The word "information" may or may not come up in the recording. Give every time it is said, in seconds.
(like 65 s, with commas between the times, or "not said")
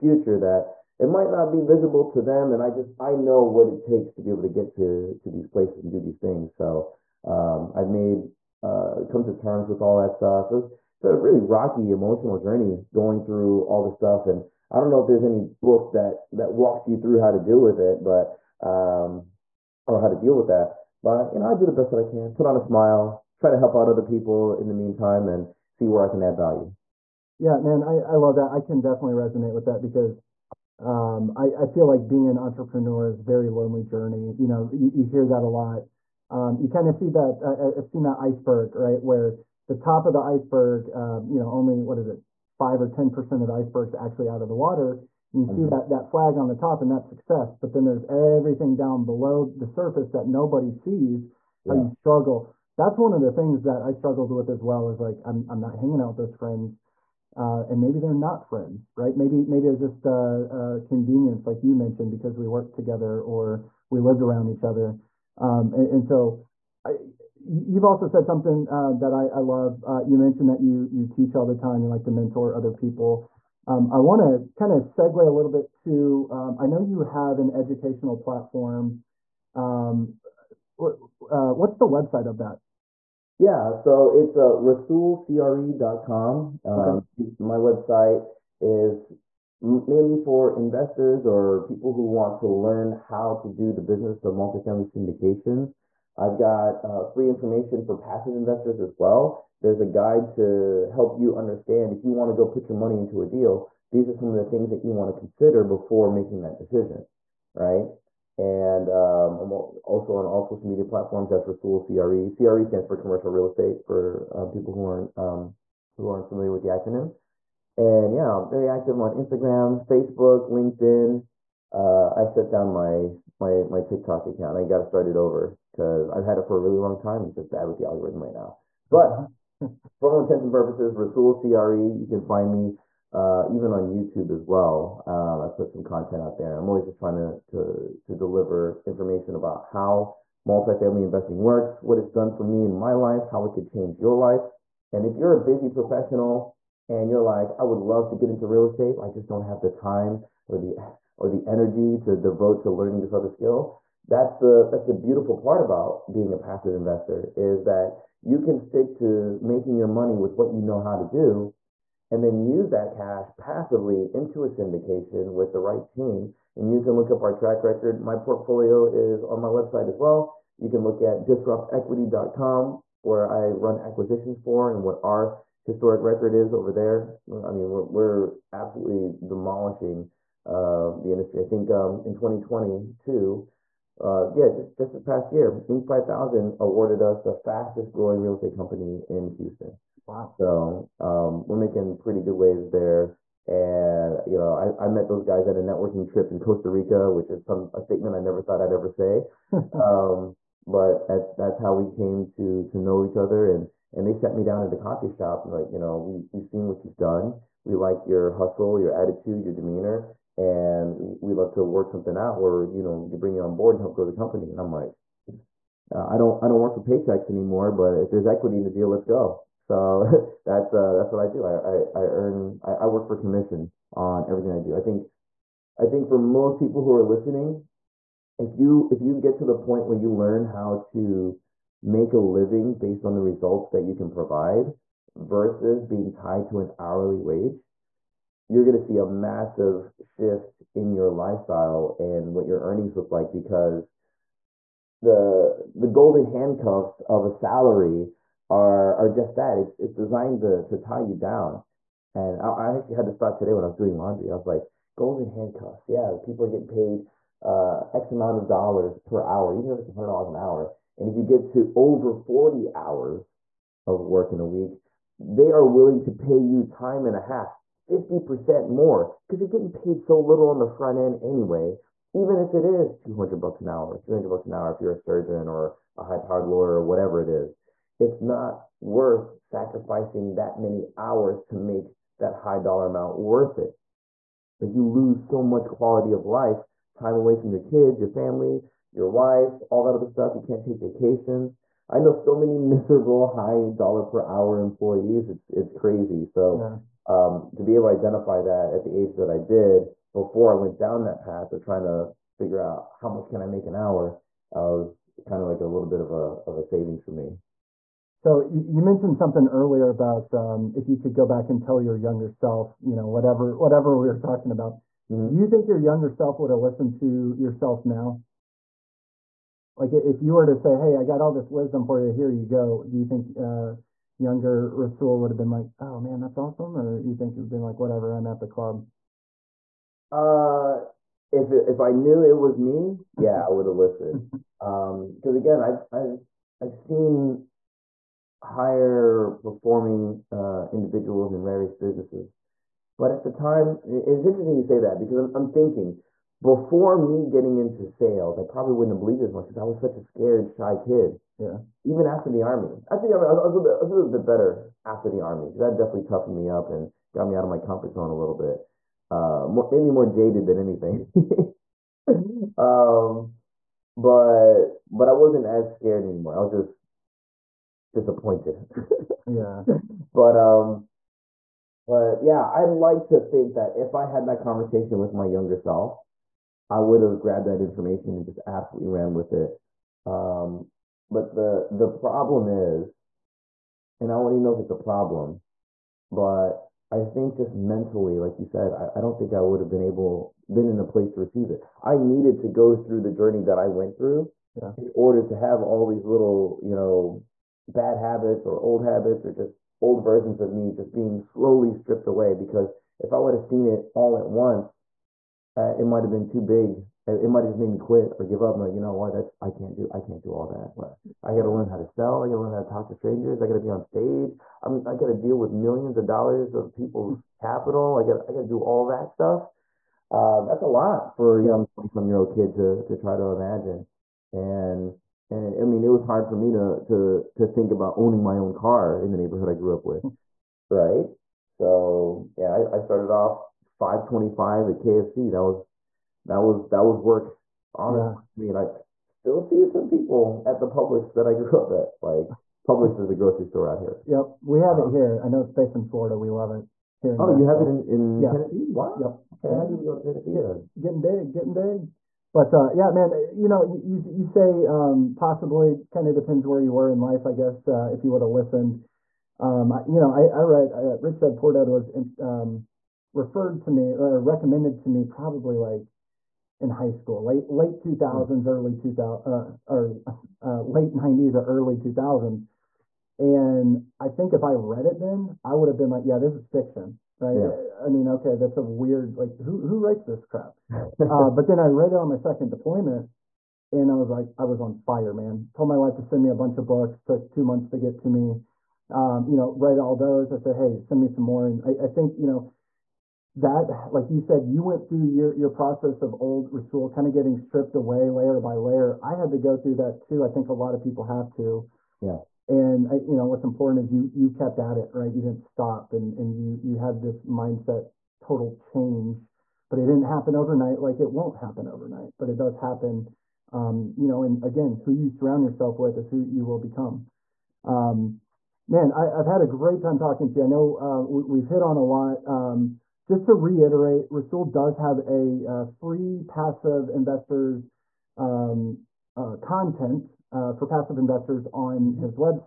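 97 s, 138 s, 377 s.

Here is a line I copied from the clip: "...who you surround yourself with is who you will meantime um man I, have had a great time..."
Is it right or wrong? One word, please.
wrong.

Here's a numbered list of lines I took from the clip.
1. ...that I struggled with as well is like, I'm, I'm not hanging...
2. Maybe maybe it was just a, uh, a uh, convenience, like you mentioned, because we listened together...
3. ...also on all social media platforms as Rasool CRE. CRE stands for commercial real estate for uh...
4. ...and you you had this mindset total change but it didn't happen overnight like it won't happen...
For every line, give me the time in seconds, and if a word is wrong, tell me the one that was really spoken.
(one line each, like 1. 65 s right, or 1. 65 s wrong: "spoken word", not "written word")
1. 53 s right
2. 59 s wrong: "worked", not "listened"
3. 109 s right
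4. 506 s right.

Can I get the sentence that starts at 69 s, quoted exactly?
Uh, you mentioned that you you teach all the time.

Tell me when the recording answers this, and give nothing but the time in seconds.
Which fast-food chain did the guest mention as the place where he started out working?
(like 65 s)
434 s.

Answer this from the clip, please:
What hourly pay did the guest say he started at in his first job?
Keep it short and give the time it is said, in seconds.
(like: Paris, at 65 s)
5.25, at 433 s.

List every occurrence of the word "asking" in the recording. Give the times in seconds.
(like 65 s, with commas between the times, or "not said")
not said.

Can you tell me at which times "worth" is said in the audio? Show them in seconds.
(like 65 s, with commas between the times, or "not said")
278 s, 283 s.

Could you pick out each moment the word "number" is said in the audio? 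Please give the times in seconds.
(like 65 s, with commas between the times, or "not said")
not said.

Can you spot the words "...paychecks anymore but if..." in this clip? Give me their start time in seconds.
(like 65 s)
216 s.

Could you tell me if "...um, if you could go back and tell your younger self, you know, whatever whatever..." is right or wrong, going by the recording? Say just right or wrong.
right.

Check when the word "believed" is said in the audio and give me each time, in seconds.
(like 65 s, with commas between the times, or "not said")
348 s.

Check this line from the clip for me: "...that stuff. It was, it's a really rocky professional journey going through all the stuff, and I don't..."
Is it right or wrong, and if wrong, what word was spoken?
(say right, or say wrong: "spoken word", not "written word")
wrong: "emotional", not "professional".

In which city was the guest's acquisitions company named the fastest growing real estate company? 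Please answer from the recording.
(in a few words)
Houston.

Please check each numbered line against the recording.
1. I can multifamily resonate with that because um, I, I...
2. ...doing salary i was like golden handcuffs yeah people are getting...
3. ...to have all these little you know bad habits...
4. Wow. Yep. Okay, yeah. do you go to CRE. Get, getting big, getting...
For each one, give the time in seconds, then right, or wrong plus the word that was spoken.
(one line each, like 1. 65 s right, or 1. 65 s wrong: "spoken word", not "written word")
1. 28 s wrong: "definitely", not "multifamily"
2. 253 s wrong: "laundry", not "salary"
3. 395 s right
4. 448 s wrong: "Tennessee", not "CRE".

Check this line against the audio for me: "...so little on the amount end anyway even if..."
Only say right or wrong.
wrong.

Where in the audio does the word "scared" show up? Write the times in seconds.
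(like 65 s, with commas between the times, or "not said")
350 s, 365 s.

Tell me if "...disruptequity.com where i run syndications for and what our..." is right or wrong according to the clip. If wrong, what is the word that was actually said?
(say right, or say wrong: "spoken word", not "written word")
wrong: "acquisitions", not "syndications".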